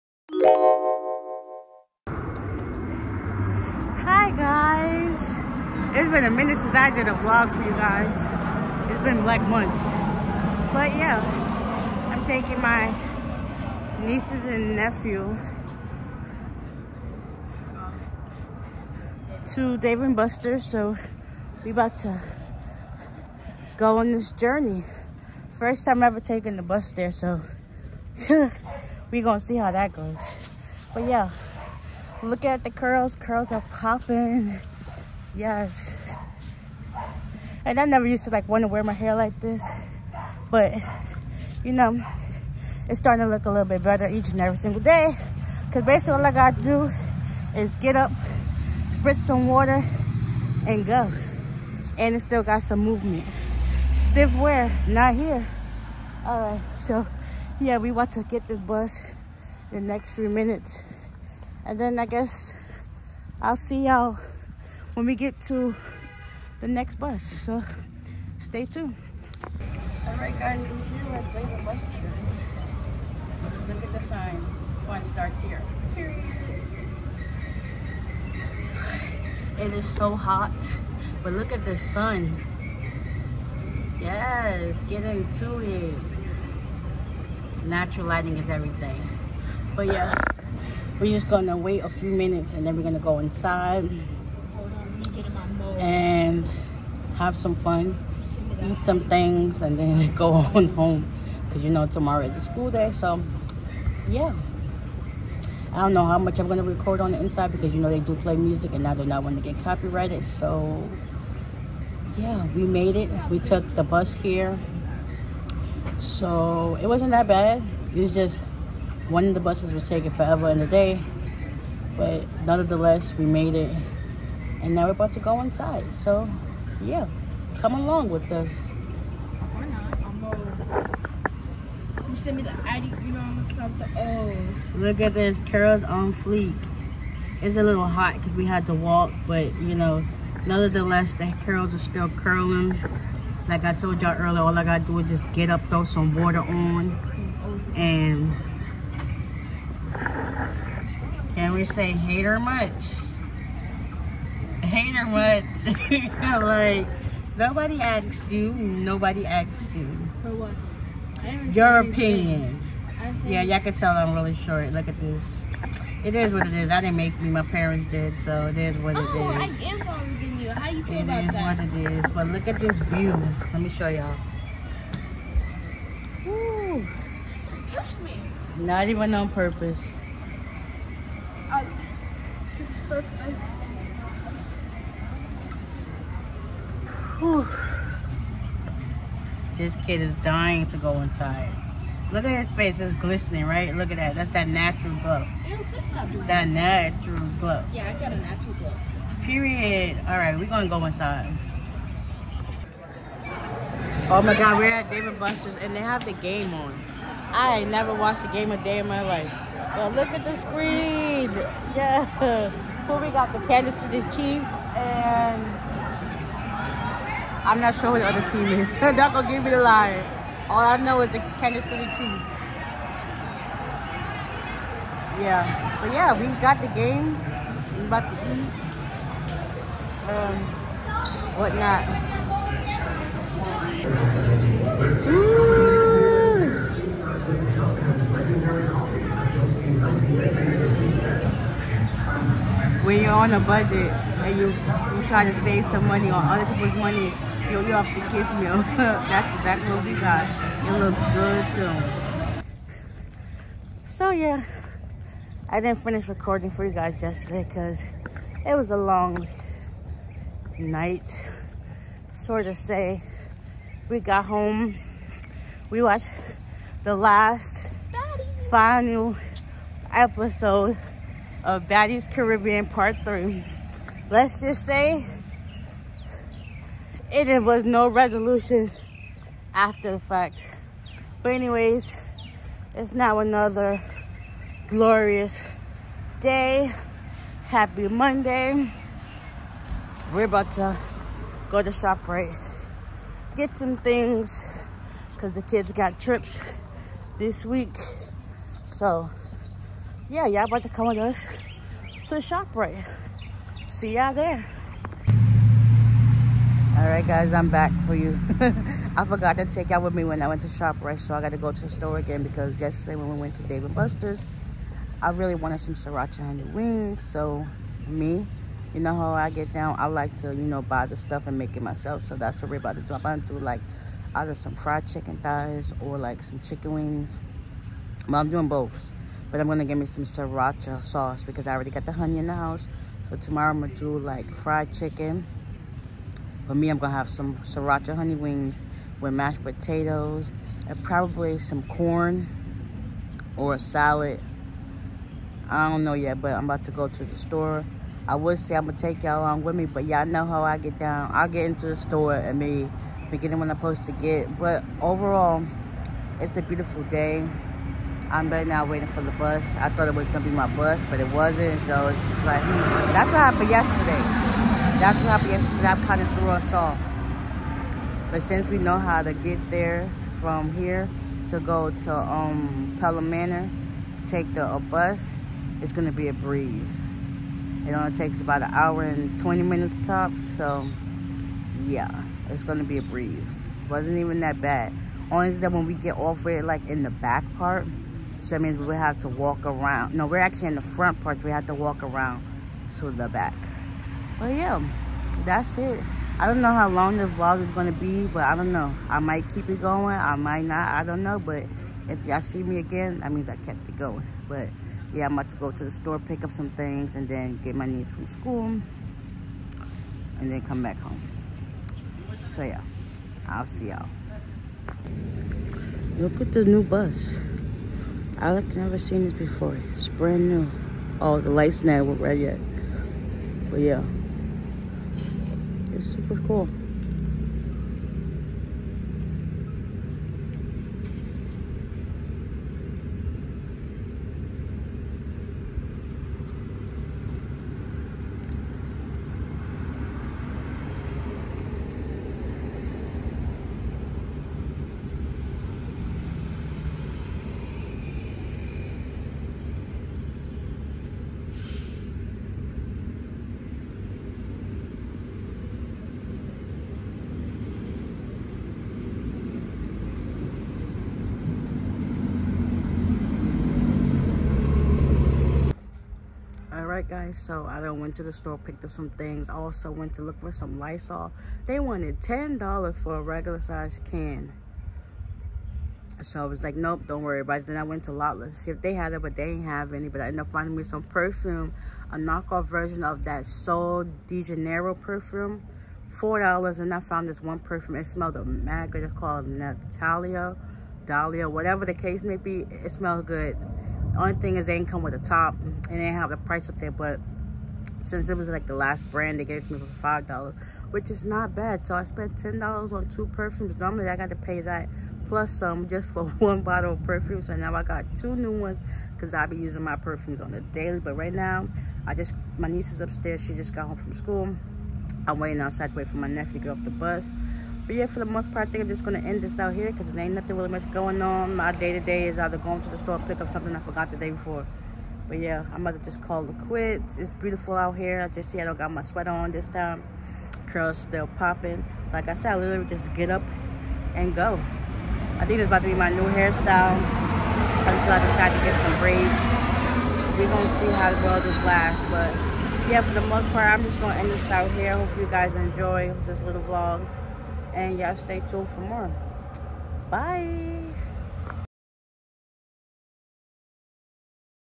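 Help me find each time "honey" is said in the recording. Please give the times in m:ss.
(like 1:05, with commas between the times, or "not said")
5:16, 5:31, 5:37.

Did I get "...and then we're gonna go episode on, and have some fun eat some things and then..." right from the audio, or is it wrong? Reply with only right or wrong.
wrong.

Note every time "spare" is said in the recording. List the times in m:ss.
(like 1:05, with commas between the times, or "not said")
not said.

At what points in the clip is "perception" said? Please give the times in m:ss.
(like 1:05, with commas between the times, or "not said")
not said.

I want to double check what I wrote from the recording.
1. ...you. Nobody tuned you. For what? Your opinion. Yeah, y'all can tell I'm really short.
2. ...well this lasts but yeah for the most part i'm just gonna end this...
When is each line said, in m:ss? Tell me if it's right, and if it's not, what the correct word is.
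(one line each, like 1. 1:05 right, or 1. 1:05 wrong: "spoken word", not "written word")
1. 2:38 wrong: "asked", not "tuned"
2. 9:01 right.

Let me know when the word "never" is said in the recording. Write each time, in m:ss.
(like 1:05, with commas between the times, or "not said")
0:37, 3:27, 6:58.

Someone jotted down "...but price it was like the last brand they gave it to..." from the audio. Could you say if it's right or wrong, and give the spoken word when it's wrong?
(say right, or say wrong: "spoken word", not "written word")
wrong: "since", not "price".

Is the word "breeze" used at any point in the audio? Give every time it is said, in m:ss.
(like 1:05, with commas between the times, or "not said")
6:16, 6:22.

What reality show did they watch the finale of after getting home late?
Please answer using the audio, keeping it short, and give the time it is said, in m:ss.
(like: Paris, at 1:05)
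Baddies Caribbean, at 4:31.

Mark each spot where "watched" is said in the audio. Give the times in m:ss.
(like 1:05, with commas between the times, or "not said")
3:27, 4:25.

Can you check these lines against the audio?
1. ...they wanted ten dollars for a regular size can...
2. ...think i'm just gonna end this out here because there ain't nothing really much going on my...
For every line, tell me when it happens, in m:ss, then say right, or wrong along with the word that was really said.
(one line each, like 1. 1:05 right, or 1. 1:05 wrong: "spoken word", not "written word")
1. 7:51 right
2. 8:38 right.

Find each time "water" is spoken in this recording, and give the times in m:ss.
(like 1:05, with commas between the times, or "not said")
0:49, 2:26.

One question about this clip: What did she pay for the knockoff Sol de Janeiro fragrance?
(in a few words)
$4.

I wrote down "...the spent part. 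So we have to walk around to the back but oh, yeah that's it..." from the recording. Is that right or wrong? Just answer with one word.
wrong.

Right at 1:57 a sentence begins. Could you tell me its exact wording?
It's just one of the buses was taking forever in the day.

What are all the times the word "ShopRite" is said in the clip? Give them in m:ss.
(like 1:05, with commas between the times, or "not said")
4:51, 5:02, 5:10.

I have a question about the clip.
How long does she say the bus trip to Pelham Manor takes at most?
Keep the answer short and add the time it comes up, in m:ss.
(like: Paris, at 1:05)
1 hour and 20 minutes, at 6:18.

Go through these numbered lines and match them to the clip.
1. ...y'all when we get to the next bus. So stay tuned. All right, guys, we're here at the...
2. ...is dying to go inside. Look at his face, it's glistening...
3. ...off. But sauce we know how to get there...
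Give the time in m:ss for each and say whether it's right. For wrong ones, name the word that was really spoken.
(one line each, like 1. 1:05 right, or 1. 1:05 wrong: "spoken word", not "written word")
1. 1:03 right
2. 3:10 right
3. 6:06 wrong: "since", not "sauce".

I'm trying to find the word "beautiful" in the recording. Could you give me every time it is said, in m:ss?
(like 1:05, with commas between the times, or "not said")
5:56, 8:47.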